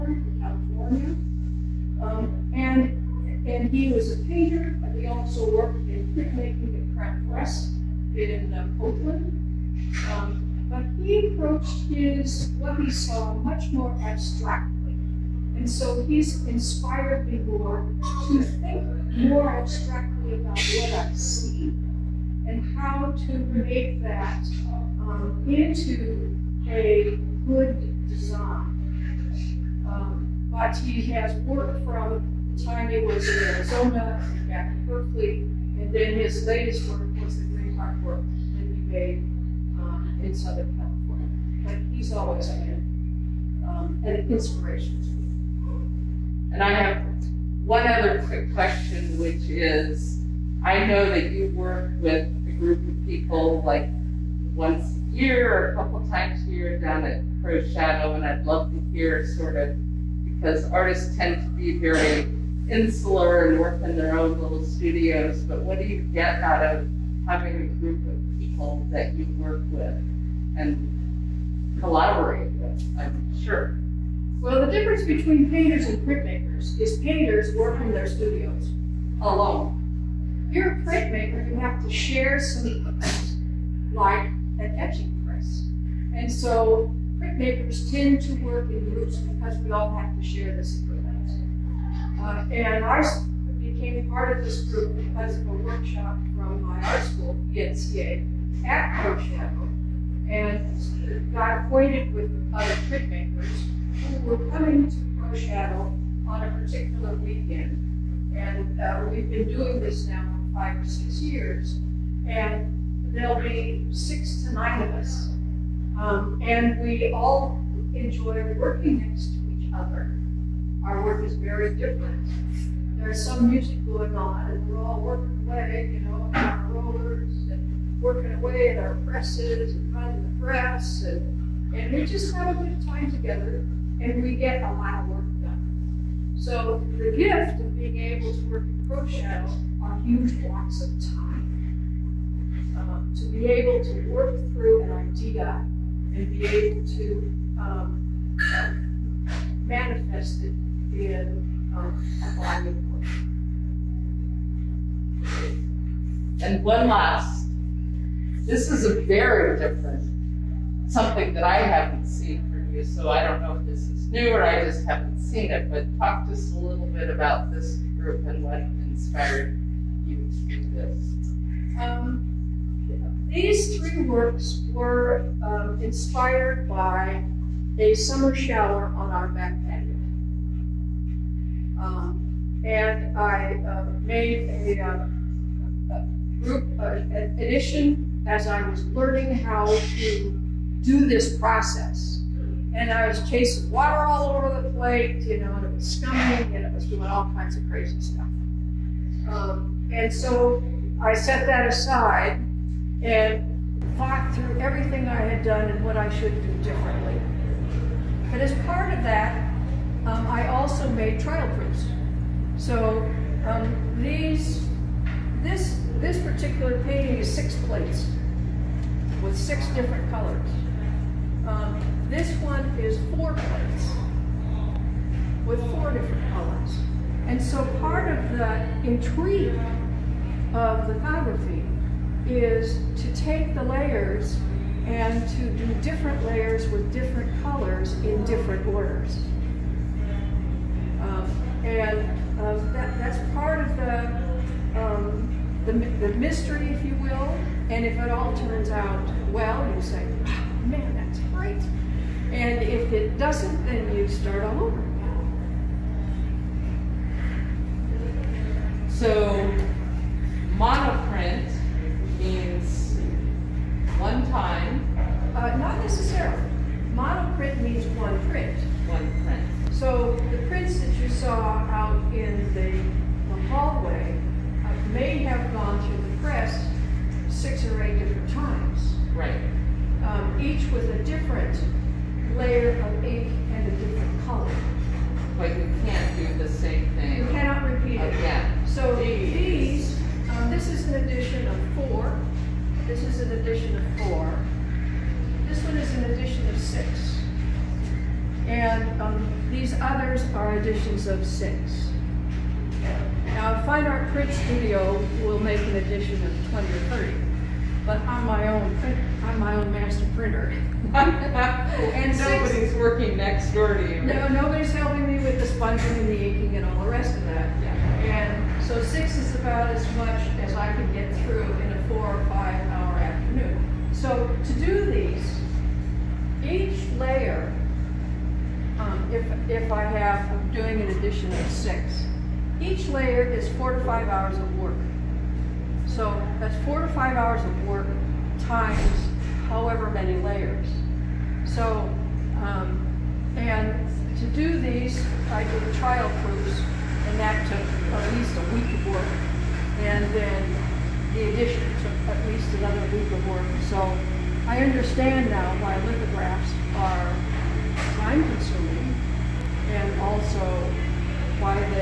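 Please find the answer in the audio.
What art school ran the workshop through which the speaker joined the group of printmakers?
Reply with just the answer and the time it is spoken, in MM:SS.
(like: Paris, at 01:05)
PNCA, at 01:37.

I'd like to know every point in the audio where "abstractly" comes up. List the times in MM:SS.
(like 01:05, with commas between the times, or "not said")
00:14, 00:19.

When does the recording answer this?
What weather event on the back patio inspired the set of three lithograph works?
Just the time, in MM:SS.
02:57.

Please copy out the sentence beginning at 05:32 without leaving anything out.
Each layer is four to five hours of work.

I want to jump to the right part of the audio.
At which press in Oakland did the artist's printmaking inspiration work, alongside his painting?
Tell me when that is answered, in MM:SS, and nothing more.
00:06.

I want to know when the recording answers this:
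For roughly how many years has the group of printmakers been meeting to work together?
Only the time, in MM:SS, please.
01:50.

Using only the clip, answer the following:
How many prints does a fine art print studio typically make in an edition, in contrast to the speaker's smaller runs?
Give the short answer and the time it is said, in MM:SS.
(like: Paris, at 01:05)
20 or 30, at 05:06.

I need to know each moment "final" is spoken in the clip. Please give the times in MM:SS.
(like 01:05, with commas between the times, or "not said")
not said.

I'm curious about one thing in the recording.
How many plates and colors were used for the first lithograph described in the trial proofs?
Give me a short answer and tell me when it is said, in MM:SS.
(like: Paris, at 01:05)
6, at 03:37.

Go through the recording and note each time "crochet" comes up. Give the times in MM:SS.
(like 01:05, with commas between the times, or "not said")
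02:18.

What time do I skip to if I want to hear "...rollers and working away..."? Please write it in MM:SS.
02:06.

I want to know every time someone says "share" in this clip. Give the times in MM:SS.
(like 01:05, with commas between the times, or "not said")
01:21, 01:30.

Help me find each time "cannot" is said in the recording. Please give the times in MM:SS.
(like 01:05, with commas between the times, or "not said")
04:47.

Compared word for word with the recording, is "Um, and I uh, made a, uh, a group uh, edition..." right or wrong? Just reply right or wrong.
right.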